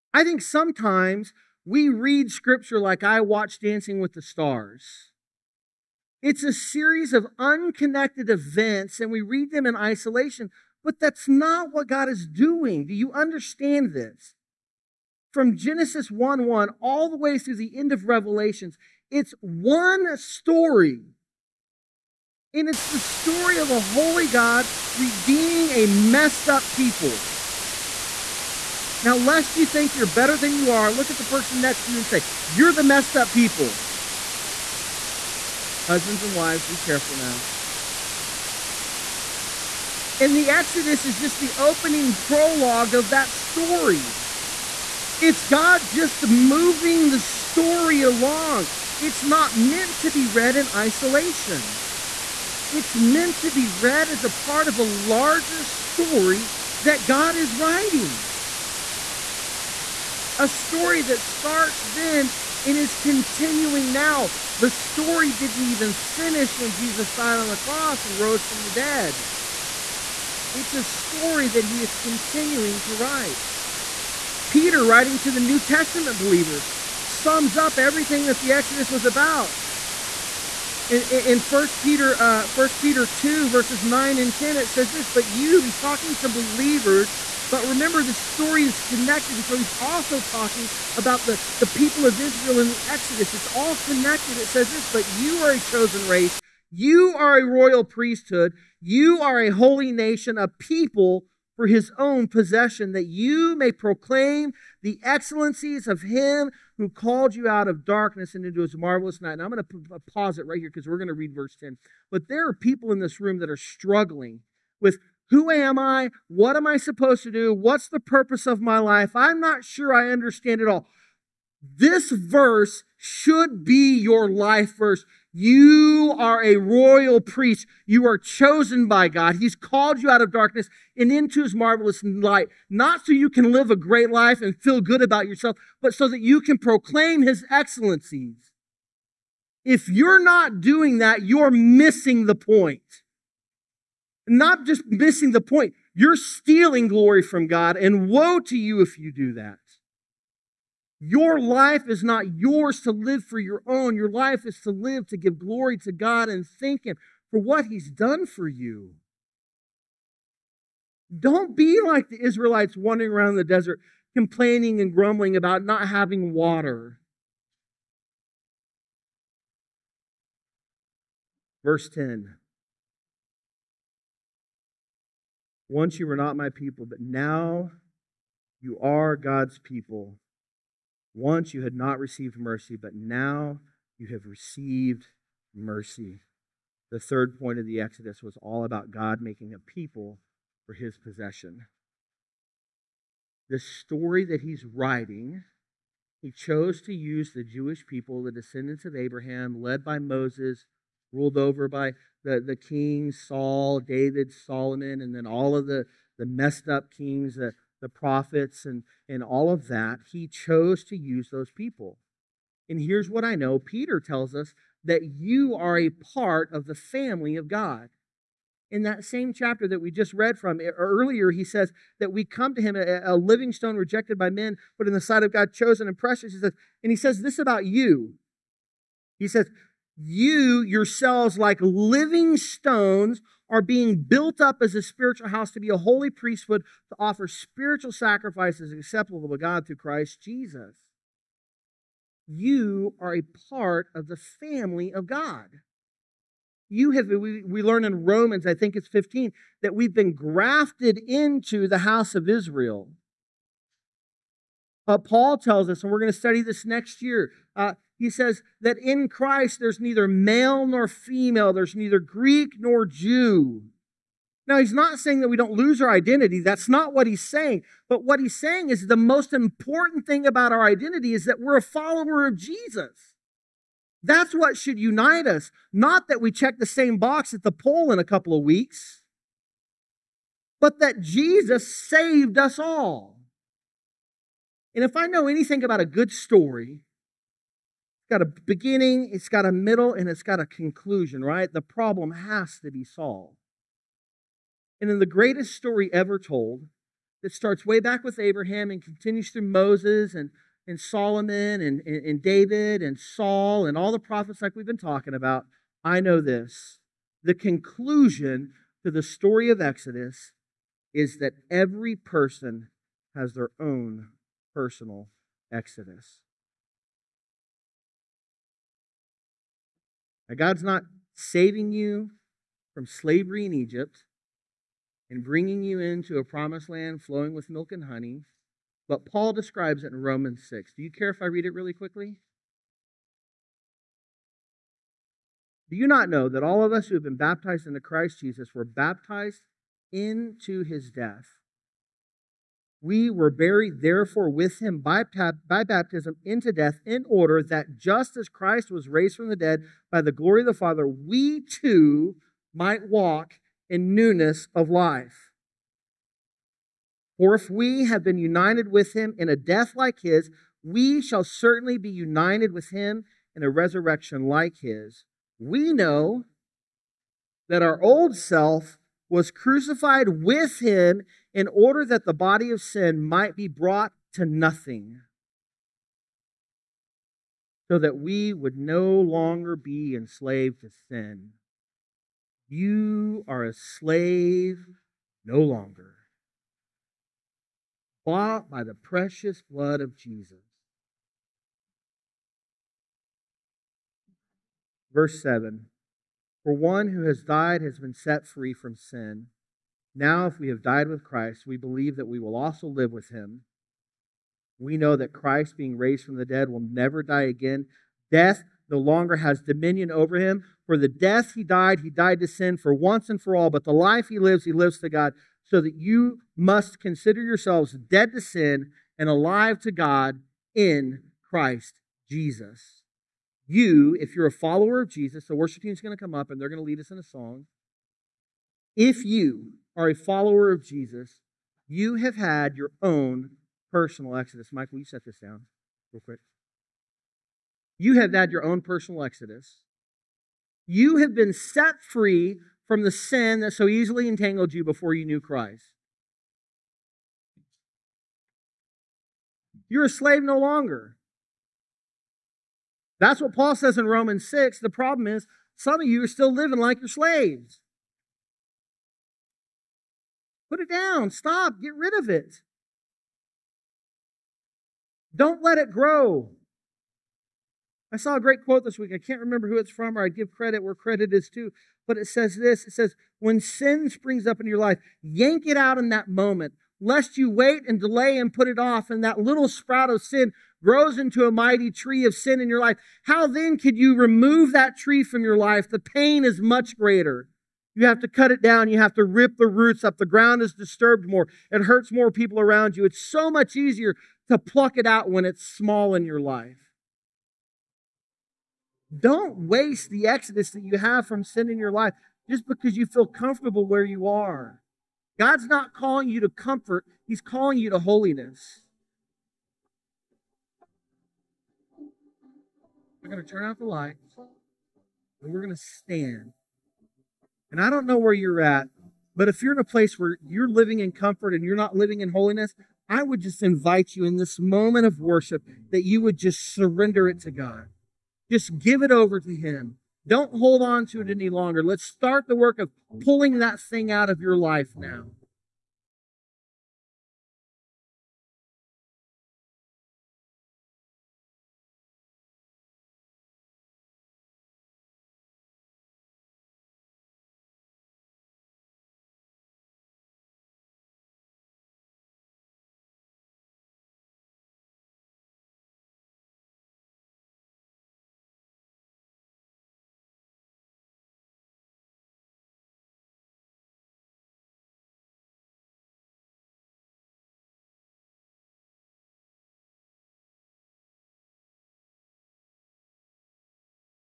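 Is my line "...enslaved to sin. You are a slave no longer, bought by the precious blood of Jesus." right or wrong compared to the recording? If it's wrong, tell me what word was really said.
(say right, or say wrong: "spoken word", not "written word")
right.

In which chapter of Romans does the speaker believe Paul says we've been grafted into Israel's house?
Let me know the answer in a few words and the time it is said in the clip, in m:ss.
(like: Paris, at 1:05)
15, at 4:08.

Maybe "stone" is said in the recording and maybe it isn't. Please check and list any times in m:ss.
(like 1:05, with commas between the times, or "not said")
3:43, 3:52.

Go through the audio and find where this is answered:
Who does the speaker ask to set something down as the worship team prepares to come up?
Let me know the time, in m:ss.
7:14.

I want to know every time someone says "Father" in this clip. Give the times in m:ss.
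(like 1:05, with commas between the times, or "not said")
5:50.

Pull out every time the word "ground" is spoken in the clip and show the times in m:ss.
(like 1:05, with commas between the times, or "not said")
8:10.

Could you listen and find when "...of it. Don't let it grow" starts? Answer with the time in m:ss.
7:41.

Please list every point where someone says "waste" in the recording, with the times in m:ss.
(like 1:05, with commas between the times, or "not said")
8:19.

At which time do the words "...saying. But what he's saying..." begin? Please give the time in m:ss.
4:27.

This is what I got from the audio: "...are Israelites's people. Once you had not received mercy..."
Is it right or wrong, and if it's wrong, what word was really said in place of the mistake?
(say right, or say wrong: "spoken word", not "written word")
wrong: "God", not "Israelites".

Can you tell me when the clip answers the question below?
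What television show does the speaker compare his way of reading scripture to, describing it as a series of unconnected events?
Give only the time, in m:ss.
0:03.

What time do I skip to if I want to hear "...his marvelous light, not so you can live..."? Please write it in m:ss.
2:11.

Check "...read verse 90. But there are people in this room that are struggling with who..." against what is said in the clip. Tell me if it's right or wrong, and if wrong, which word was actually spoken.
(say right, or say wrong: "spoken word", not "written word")
wrong: "10", not "90".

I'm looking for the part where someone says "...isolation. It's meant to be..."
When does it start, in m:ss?
0:50.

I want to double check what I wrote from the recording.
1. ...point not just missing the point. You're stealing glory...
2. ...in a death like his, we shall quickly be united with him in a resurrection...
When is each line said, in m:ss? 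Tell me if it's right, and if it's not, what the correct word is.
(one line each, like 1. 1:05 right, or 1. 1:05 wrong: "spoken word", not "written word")
1. 2:22 right
2. 5:59 wrong: "certainly", not "quickly".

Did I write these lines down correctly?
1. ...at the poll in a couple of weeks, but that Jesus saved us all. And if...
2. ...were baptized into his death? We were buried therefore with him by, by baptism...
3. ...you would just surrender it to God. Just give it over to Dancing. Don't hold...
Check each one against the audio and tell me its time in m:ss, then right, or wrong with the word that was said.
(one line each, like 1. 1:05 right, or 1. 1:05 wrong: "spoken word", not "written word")
1. 4:37 right
2. 5:38 right
3. 8:45 wrong: "Him", not "Dancing".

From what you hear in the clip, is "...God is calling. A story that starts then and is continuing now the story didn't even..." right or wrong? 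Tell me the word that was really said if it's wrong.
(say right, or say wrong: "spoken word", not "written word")
wrong: "writing", not "calling".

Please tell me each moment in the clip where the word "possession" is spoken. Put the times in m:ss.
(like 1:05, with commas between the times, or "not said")
1:42, 3:10.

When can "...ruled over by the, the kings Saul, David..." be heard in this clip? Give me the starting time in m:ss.
3:21.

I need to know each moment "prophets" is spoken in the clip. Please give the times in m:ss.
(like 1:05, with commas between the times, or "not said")
3:27, 5:03.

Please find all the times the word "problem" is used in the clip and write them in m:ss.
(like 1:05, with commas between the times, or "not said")
4:51, 7:34.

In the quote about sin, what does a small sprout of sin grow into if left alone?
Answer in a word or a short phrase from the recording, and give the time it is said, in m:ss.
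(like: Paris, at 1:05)
A mighty tree, at 8:01.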